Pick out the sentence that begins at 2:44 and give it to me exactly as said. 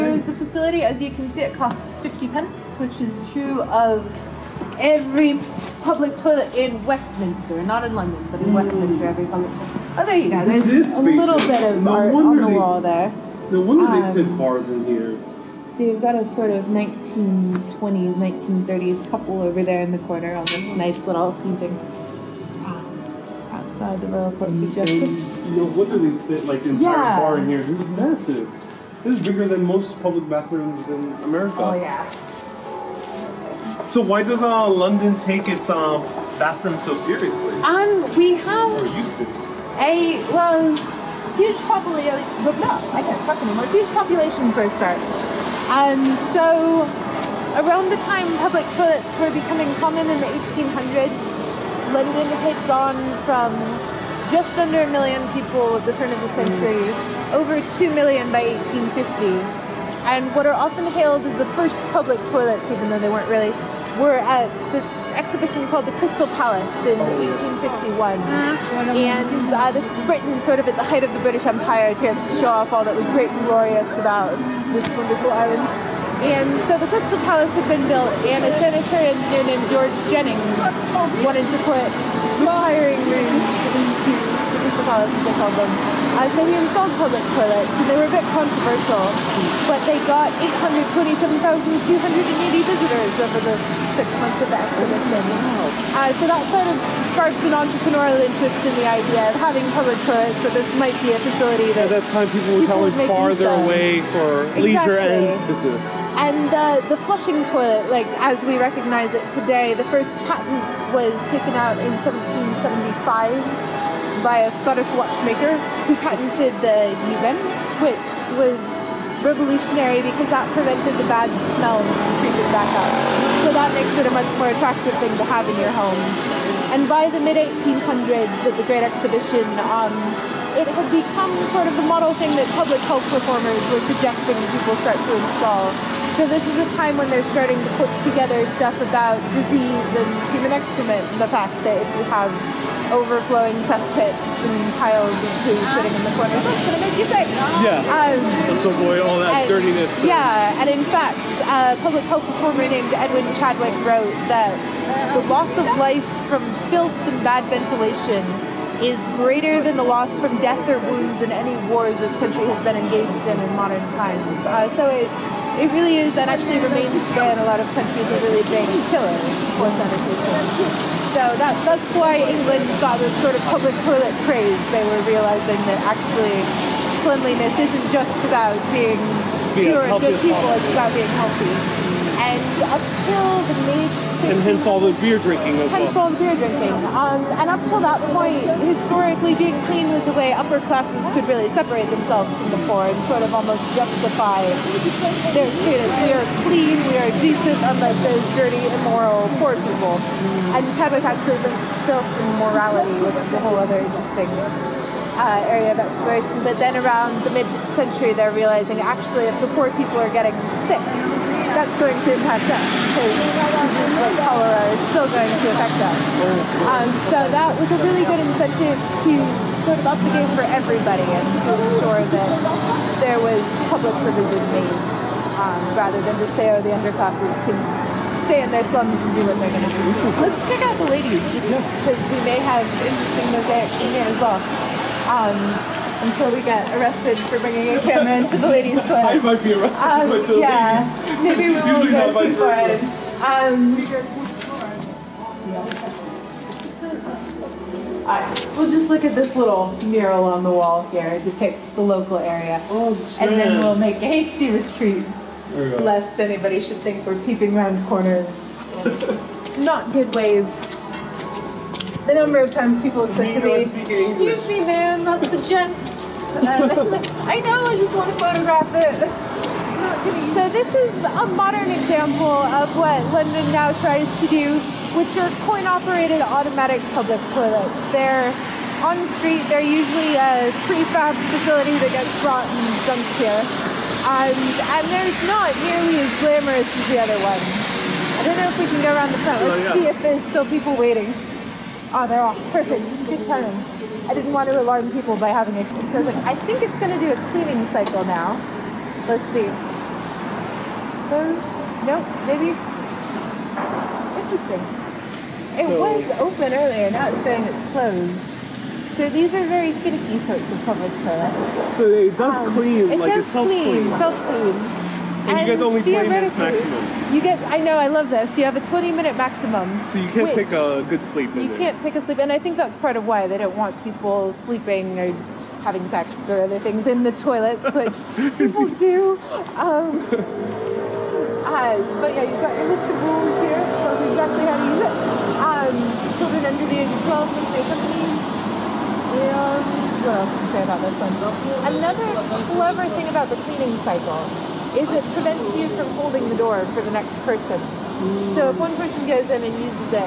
Uh, so it, it really is, and actually remains today in a lot of countries, a really big killer for sanitation.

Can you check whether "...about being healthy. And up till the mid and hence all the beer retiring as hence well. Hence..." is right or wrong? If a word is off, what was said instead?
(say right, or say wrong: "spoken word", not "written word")
wrong: "drinking", not "retiring".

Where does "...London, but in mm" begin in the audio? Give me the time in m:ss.
0:07.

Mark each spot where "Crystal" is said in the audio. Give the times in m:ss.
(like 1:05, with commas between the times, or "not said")
1:06, 1:16, 1:24.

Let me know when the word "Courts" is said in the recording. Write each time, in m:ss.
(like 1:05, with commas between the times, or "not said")
0:24.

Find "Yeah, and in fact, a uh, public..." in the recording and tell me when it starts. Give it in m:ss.
2:30.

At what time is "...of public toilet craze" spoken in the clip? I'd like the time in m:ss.
2:53.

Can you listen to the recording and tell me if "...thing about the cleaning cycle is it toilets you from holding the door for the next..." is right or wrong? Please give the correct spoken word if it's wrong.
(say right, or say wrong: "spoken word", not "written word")
wrong: "prevents", not "toilets".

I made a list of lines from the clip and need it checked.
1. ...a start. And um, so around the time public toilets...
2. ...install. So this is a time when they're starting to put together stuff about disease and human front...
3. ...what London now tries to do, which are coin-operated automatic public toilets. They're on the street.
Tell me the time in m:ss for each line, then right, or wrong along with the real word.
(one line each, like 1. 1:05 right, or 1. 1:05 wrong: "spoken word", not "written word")
1. 0:44 right
2. 2:15 wrong: "excrement", not "front"
3. 4:32 right.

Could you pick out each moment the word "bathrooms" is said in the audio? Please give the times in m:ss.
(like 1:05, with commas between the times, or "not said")
0:30, 0:36.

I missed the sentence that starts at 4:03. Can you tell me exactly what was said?
Um, right, we'll just look at this little mural on the wall here.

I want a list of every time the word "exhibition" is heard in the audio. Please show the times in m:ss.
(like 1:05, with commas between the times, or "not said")
1:05, 2:08.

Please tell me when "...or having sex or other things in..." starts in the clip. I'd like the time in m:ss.
5:24.